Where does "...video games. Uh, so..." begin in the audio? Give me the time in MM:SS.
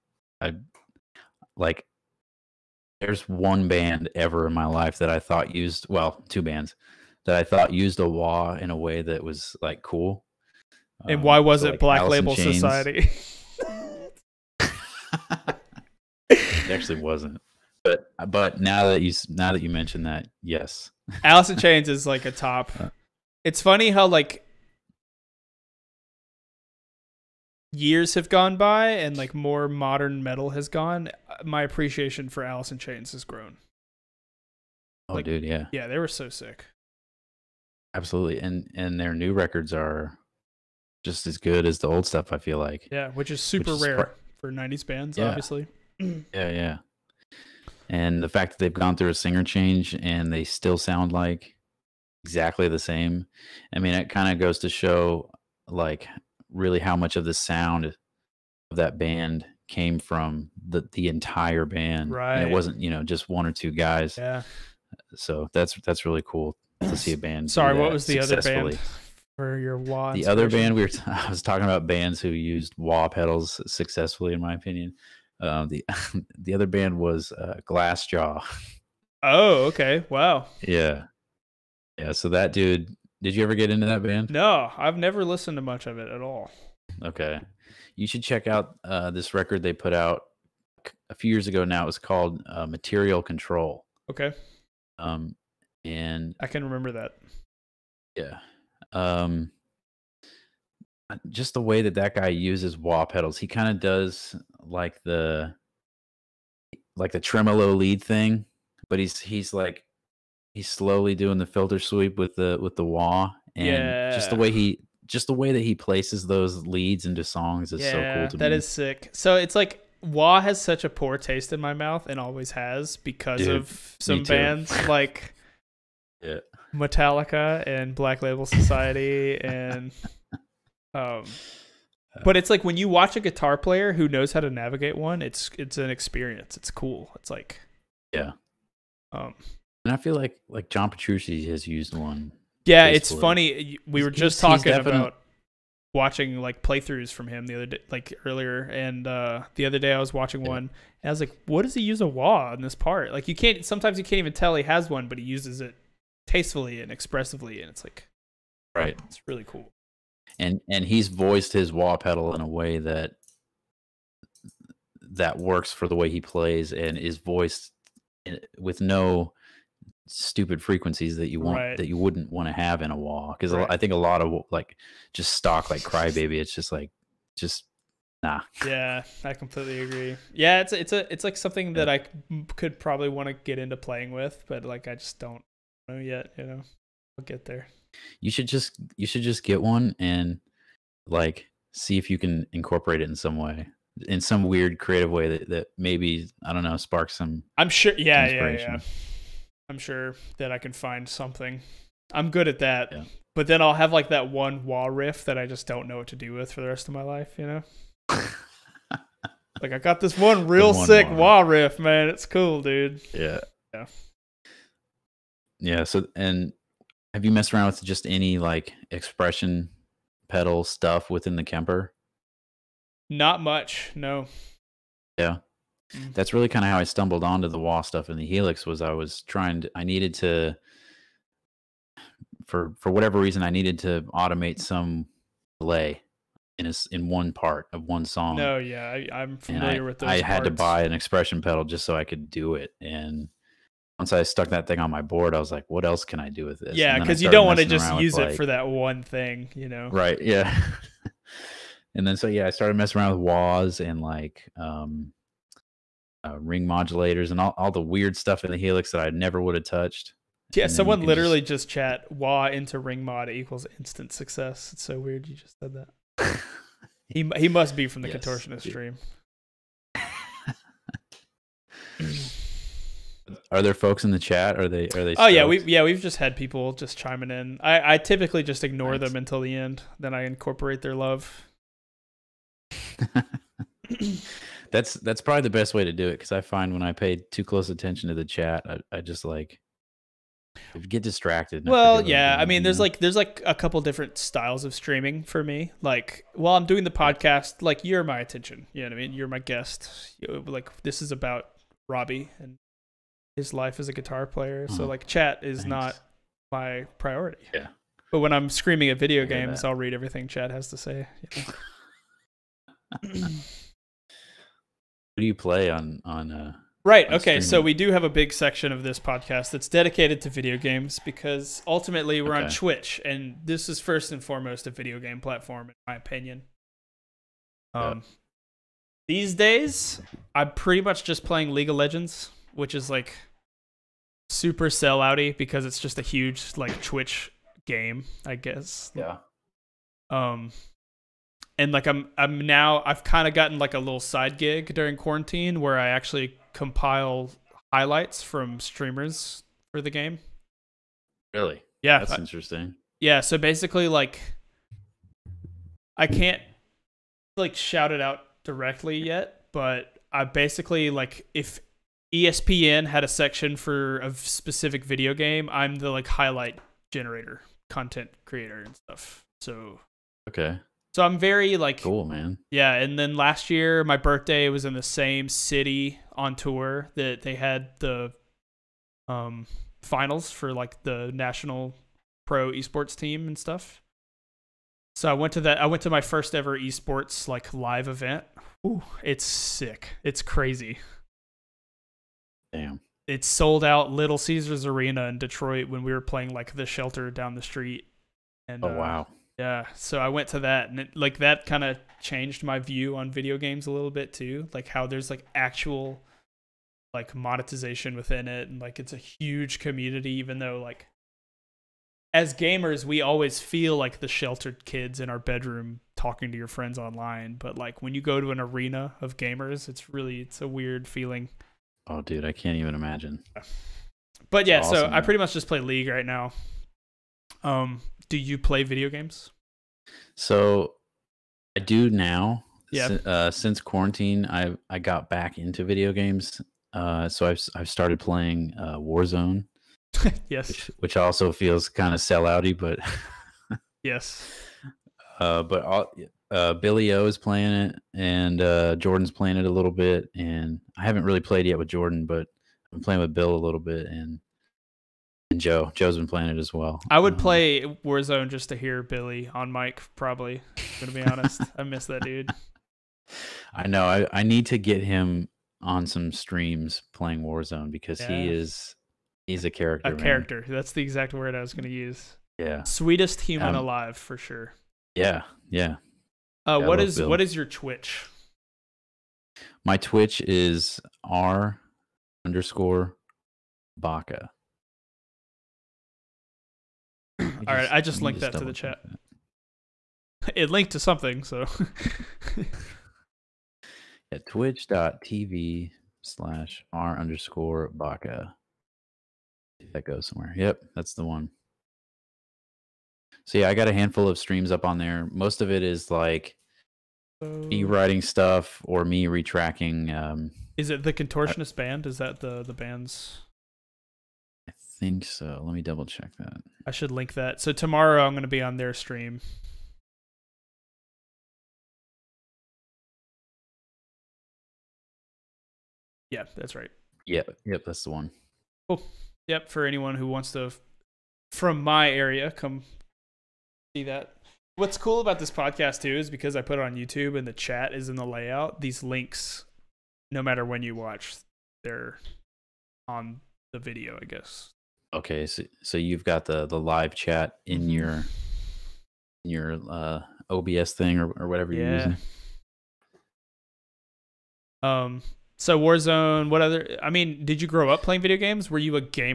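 07:15.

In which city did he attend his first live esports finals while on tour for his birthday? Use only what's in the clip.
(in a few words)
Detroit.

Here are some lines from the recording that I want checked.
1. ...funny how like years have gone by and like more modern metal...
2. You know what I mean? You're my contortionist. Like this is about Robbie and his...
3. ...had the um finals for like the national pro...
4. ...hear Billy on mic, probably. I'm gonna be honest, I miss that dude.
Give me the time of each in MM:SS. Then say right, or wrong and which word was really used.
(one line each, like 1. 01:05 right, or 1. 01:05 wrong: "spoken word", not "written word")
1. 00:23 right
2. 04:58 wrong: "guest", not "contortionist"
3. 06:17 right
4. 07:38 right.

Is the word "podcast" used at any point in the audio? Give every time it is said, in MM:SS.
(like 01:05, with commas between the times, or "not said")
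04:56, 05:18, 08:55.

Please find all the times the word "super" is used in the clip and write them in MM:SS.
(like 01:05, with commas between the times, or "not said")
00:43, 05:34.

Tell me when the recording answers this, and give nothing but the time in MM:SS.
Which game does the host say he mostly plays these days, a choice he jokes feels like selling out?
05:31.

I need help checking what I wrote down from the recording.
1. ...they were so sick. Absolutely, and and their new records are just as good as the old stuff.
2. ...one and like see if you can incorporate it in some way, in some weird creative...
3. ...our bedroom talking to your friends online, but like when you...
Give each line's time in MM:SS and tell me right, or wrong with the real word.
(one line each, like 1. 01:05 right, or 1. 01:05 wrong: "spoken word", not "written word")
1. 00:35 right
2. 03:09 right
3. 06:55 right.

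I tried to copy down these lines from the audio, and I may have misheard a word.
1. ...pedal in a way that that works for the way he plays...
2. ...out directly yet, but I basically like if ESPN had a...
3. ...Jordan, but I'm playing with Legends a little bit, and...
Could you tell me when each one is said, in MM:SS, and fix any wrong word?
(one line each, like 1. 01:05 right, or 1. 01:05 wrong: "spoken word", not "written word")
1. 02:41 right
2. 05:57 right
3. 07:31 wrong: "Bill", not "Legends".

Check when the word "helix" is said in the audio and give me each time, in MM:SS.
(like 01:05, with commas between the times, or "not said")
03:48, 04:18.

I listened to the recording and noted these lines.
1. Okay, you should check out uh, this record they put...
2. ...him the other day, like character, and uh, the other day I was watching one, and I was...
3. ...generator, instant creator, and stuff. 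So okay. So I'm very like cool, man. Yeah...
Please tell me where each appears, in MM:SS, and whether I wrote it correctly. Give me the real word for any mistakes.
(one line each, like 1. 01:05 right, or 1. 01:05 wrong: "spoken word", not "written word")
1. 01:27 right
2. 02:27 wrong: "earlier", not "character"
3. 06:06 wrong: "content", not "instant".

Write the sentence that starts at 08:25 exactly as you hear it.
Most of it is like me writing stuff or me retracking.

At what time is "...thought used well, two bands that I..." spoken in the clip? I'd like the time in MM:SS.
00:05.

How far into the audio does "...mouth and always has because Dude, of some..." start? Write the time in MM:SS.
02:01.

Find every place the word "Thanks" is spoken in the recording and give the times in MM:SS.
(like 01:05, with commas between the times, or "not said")
05:05.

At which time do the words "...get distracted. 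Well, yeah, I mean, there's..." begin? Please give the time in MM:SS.
04:50.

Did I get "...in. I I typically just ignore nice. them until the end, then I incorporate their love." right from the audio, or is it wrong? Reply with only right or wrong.
right.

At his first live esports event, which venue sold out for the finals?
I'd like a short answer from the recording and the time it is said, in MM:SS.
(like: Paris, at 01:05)
Little Caesars Arena, at 06:33.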